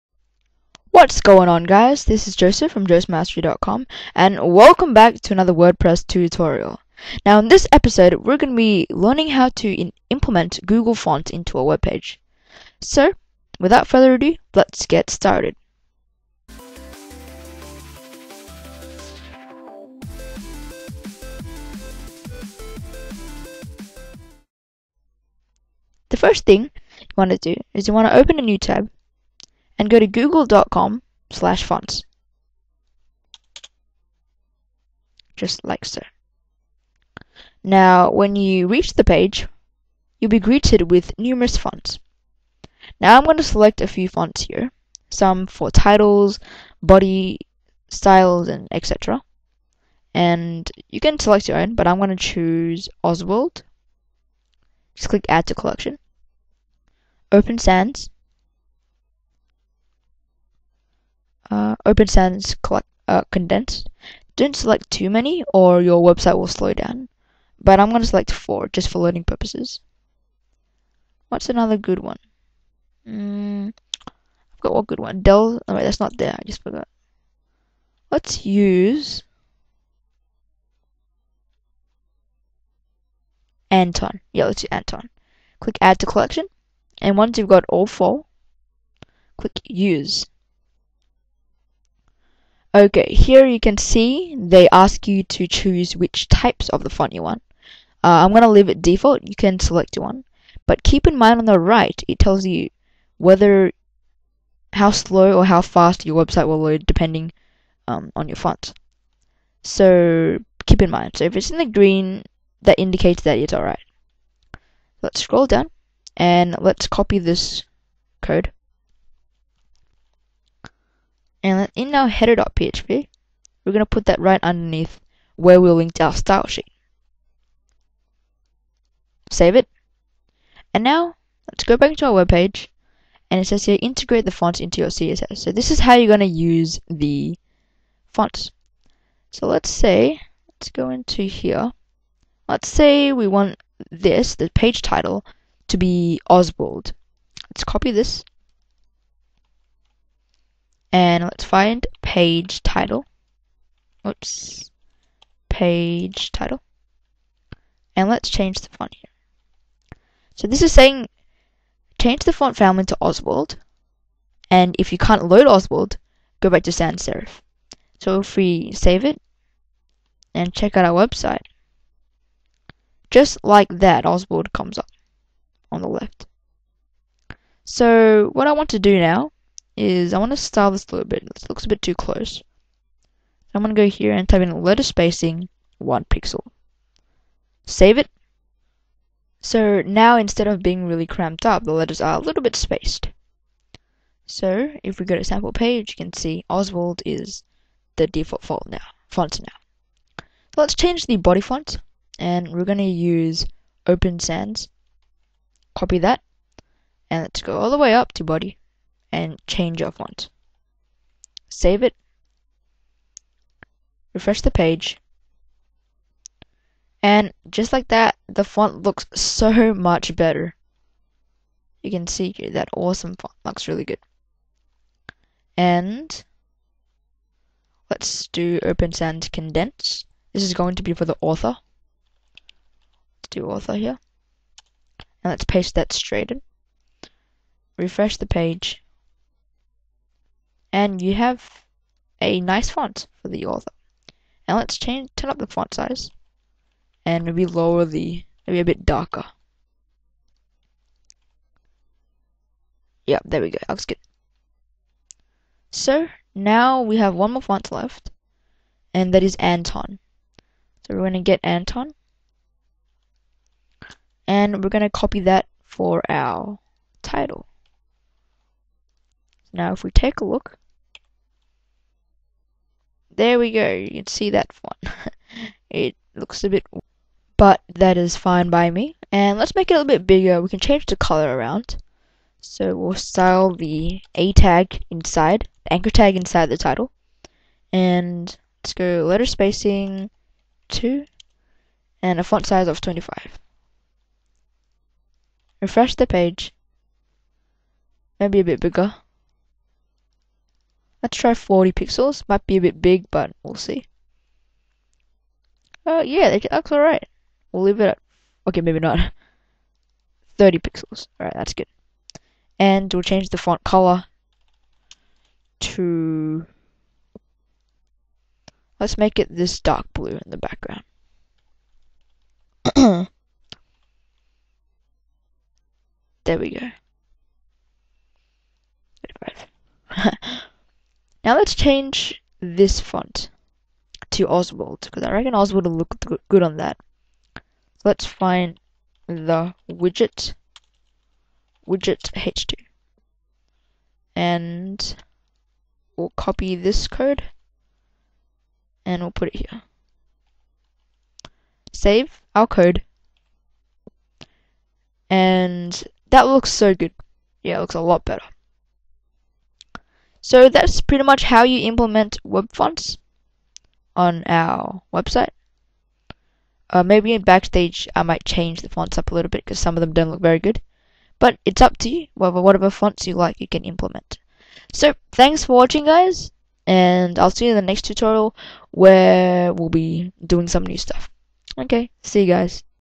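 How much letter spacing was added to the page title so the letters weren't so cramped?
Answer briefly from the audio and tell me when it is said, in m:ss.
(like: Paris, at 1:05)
1 pixel, at 3:05.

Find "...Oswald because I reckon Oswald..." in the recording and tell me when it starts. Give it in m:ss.
5:34.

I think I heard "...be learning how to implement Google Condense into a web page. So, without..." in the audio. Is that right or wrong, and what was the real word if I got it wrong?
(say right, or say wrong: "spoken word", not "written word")
wrong: "Fonts", not "Condense".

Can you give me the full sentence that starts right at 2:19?
So let's say, let's go into here.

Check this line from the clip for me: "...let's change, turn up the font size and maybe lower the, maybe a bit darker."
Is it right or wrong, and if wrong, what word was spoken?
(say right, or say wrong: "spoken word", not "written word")
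right.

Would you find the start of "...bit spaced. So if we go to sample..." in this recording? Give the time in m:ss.
3:12.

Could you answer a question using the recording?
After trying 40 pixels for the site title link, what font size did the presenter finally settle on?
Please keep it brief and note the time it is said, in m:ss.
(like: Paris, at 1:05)
30 pixels, at 5:10.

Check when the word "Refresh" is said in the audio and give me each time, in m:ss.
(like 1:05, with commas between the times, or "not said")
3:34, 3:57, 4:55.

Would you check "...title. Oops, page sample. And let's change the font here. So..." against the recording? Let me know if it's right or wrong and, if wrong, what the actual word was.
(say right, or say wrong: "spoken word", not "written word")
wrong: "title", not "sample".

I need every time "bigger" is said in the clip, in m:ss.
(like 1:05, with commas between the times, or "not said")
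4:40, 4:58.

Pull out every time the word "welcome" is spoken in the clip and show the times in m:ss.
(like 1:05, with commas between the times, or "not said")
0:04.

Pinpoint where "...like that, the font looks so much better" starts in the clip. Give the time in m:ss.
3:37.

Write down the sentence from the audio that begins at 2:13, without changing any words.
And it says here, integrate the font into your CSS.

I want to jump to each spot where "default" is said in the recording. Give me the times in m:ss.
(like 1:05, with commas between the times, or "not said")
1:38, 3:18.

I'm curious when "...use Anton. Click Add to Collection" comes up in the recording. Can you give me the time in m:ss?
1:24.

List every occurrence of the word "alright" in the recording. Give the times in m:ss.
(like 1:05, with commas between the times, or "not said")
1:53, 5:06, 5:11.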